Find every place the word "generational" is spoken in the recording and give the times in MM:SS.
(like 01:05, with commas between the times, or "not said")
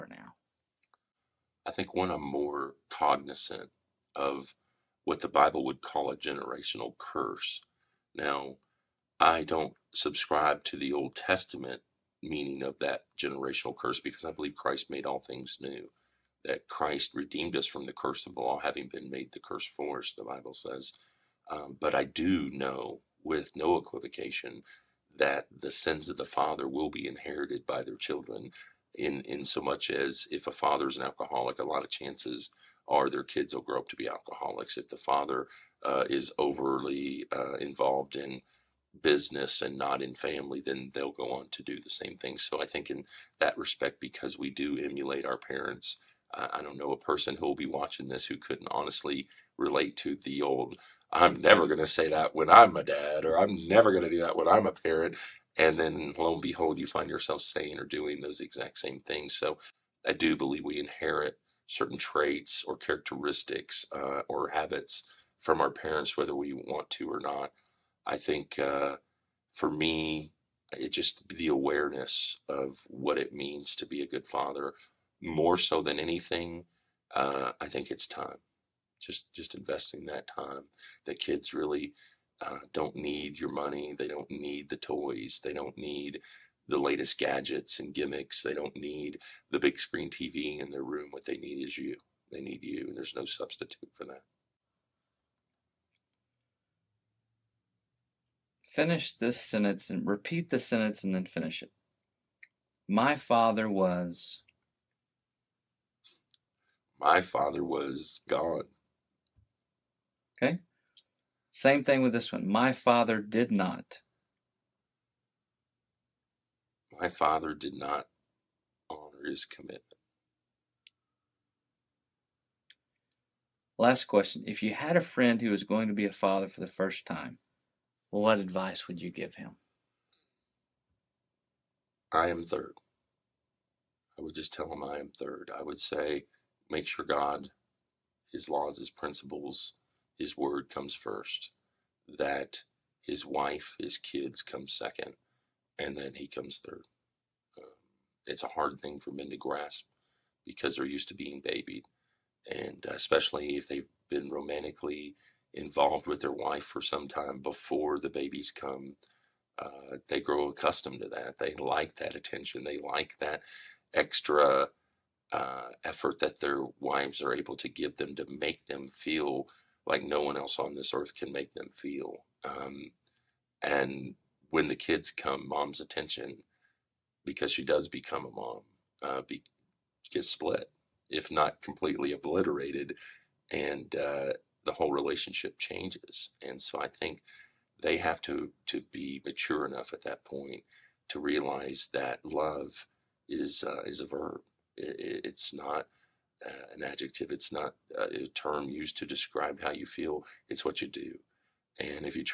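00:06, 00:13.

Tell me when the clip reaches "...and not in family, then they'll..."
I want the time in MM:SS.
00:39.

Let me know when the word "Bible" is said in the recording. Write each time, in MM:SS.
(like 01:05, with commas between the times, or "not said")
00:05, 00:20.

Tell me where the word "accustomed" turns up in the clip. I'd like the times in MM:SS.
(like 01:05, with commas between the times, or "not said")
02:40.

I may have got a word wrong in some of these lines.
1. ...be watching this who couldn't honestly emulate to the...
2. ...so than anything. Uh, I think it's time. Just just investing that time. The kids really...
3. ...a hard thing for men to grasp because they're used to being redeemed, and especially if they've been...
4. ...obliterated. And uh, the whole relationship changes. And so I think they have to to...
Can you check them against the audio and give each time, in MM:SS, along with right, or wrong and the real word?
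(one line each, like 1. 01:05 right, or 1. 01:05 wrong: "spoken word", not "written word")
1. 00:47 wrong: "relate", not "emulate"
2. 01:15 right
3. 02:28 wrong: "babied", not "redeemed"
4. 03:02 right.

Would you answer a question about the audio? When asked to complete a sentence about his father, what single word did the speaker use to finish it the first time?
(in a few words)
gone.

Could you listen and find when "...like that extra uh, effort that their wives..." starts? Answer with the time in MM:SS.
02:42.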